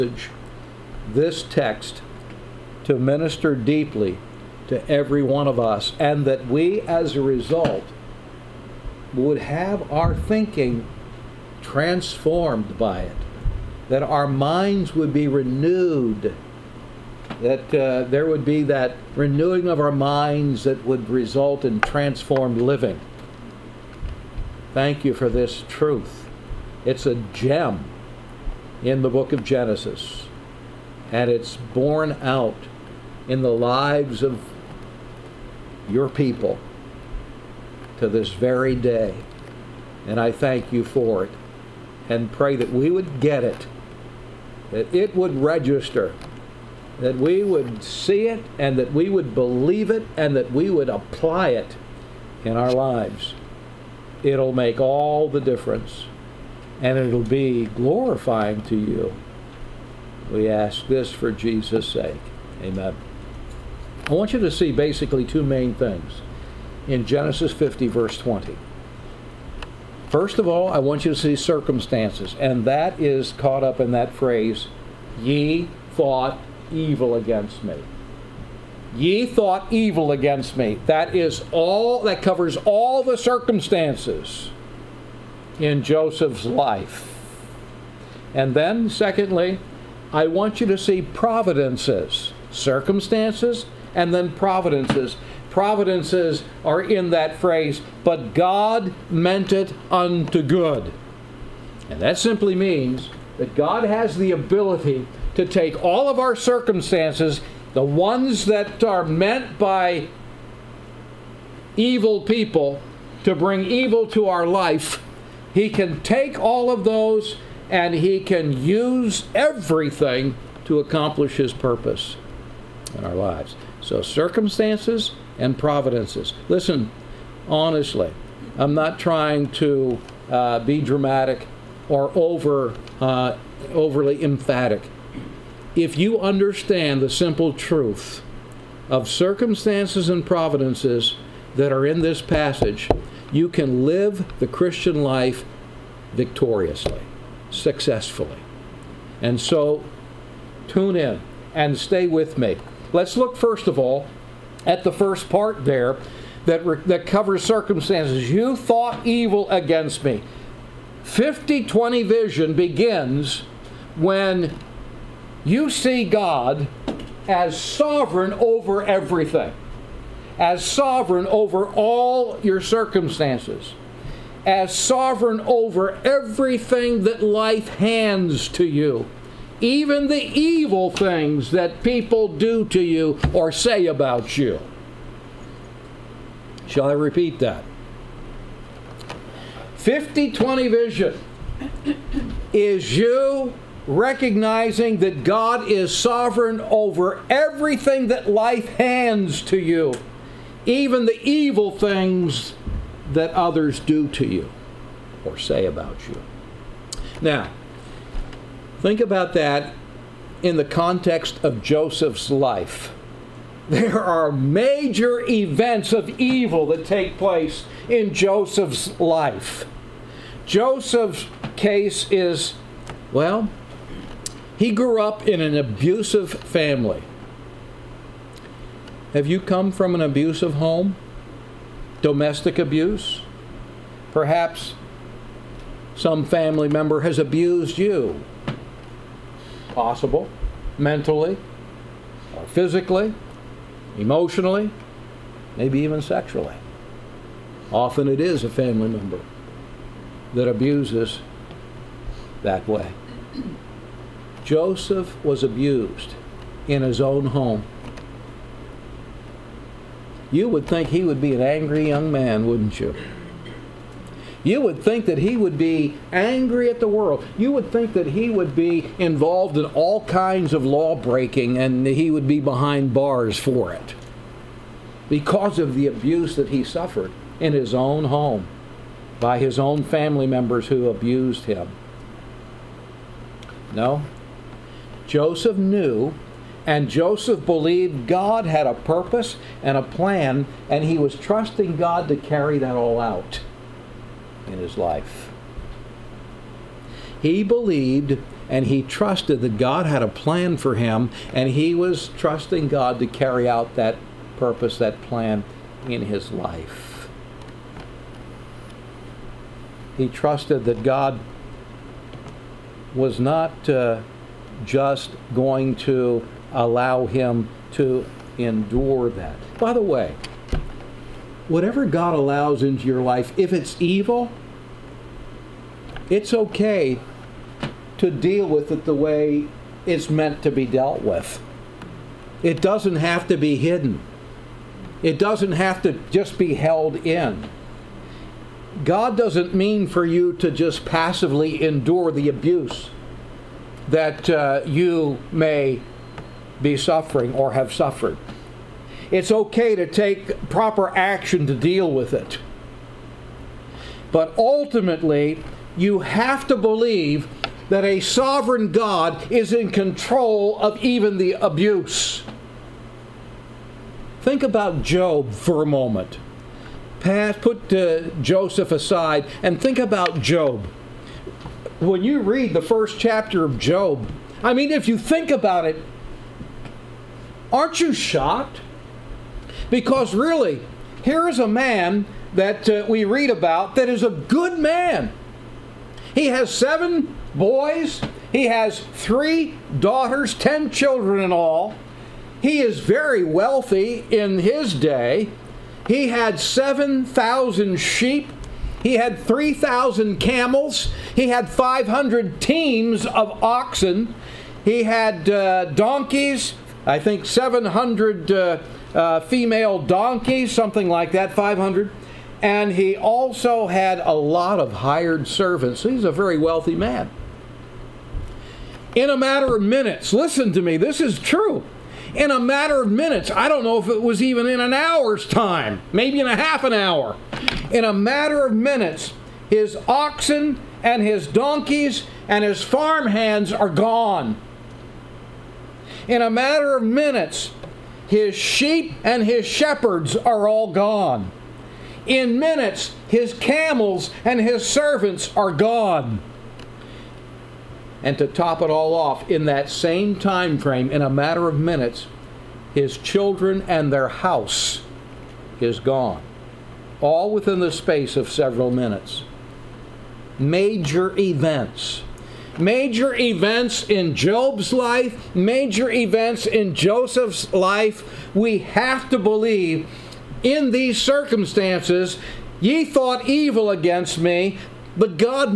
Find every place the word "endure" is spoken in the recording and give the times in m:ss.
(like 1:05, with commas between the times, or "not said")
5:18, 5:41.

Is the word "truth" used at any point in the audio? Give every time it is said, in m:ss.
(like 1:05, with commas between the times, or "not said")
0:25, 2:17.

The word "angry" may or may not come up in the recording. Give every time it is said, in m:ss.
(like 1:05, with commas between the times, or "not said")
4:21, 4:26.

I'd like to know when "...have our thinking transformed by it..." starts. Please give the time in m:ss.
0:09.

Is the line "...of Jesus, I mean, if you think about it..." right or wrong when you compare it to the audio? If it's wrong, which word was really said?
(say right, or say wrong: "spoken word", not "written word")
wrong: "Job", not "Jesus".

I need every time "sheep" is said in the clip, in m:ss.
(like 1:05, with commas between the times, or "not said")
6:37, 7:18.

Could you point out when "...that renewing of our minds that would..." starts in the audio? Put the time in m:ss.
0:18.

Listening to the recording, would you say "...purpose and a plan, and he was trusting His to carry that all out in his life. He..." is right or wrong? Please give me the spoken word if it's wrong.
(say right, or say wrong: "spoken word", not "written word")
wrong: "God", not "His".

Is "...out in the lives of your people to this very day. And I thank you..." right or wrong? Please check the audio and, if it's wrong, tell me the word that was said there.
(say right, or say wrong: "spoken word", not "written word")
right.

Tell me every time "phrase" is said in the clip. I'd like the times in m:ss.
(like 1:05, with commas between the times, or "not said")
1:14, 1:37.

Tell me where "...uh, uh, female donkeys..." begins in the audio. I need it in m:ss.
6:48.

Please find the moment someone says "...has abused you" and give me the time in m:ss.
3:57.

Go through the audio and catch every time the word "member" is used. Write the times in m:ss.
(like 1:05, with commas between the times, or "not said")
3:56, 4:08, 4:40.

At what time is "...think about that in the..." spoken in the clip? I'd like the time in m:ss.
3:28.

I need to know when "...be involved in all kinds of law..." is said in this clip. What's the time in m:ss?
4:28.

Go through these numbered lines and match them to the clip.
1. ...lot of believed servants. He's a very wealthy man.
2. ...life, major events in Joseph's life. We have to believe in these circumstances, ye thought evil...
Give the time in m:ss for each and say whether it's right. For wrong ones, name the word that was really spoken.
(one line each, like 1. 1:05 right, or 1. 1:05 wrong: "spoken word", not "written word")
1. 6:54 wrong: "hired", not "believed"
2. 7:44 right.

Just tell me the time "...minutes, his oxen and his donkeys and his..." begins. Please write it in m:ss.
7:08.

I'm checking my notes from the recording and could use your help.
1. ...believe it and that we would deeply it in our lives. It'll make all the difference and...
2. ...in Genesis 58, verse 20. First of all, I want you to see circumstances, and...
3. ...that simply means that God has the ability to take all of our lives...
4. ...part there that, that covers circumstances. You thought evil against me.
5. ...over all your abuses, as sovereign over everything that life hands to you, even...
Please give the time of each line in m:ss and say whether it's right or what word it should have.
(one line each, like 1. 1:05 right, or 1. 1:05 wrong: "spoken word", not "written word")
1. 0:49 wrong: "apply", not "deeply"
2. 1:06 wrong: "50", not "58"
3. 1:42 wrong: "circumstances", not "lives"
4. 2:35 right
5. 2:51 wrong: "circumstances", not "abuses".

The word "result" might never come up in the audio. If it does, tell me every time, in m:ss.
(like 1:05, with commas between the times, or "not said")
0:07, 0:21.